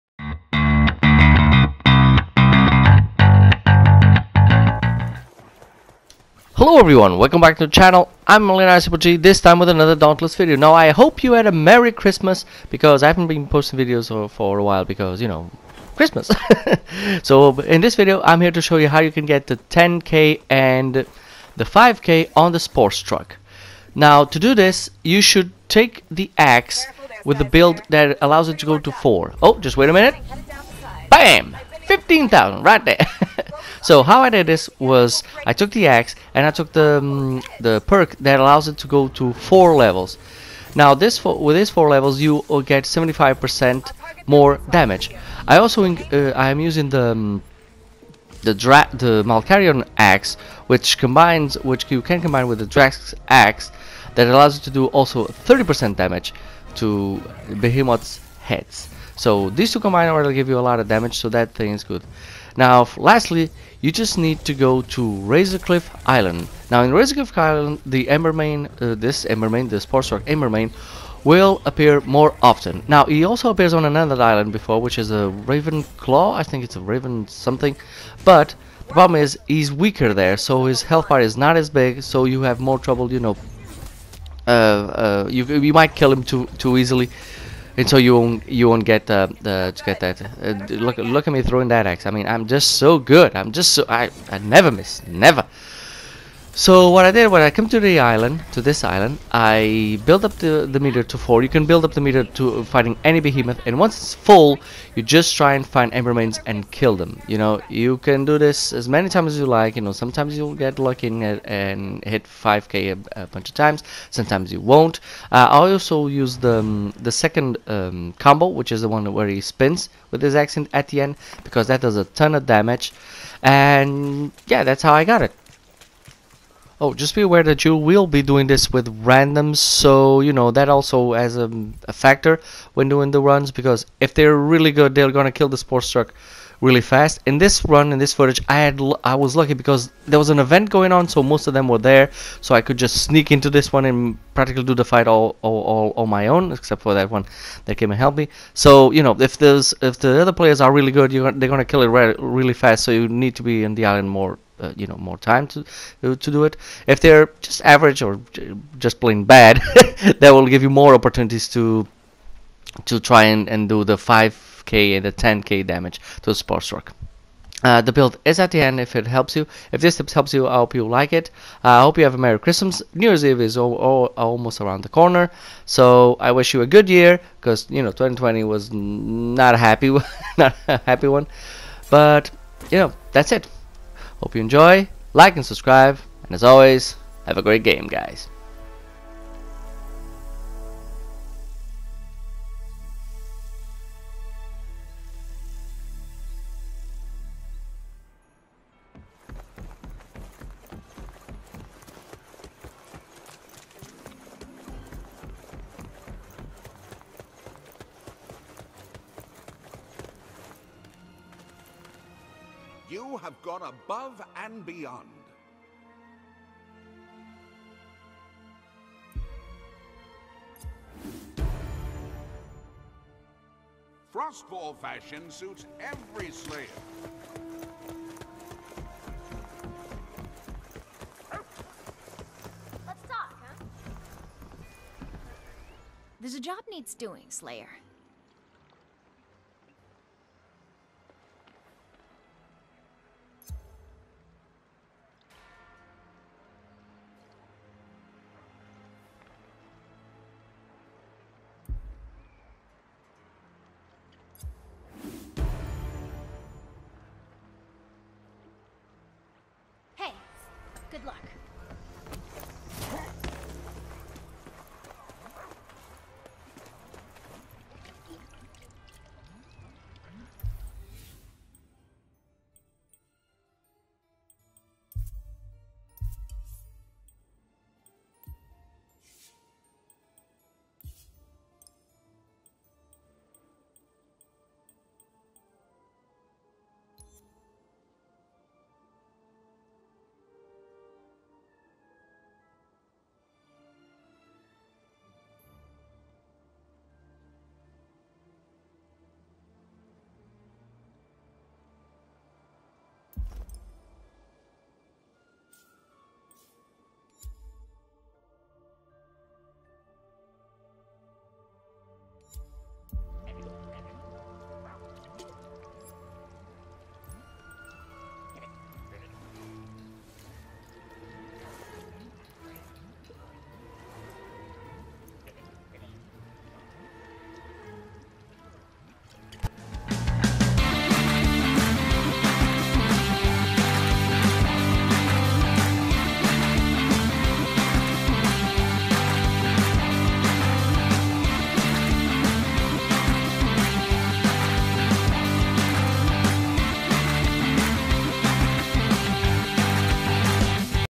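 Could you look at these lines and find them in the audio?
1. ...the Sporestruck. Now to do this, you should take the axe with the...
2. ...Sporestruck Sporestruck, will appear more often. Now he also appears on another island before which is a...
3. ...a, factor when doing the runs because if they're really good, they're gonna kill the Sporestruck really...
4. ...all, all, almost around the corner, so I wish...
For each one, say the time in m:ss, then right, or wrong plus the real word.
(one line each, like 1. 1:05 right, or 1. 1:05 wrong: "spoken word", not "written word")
1. 0:22 right
2. 1:09 wrong: "Embermane", not "Sporestruck"
3. 2:11 right
4. 2:53 right.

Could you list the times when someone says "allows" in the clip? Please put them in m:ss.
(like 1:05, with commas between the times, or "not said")
0:28, 0:38, 0:54.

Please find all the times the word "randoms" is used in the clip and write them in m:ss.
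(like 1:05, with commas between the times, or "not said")
2:09.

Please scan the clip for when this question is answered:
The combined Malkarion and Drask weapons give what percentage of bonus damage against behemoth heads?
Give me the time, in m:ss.
0:55.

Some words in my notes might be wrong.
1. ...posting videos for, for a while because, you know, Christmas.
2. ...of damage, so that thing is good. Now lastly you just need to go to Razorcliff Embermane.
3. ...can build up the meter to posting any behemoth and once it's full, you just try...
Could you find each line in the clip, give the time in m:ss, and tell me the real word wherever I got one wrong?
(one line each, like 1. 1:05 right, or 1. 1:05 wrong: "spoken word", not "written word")
1. 0:13 right
2. 1:00 wrong: "Island", not "Embermane"
3. 1:41 wrong: "fighting", not "posting".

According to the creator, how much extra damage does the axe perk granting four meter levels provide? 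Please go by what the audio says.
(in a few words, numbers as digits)
75%.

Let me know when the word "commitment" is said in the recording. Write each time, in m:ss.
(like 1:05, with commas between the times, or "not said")
not said.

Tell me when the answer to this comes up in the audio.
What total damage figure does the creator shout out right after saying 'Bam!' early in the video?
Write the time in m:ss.
0:31.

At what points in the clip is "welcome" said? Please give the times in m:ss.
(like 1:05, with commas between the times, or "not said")
0:07.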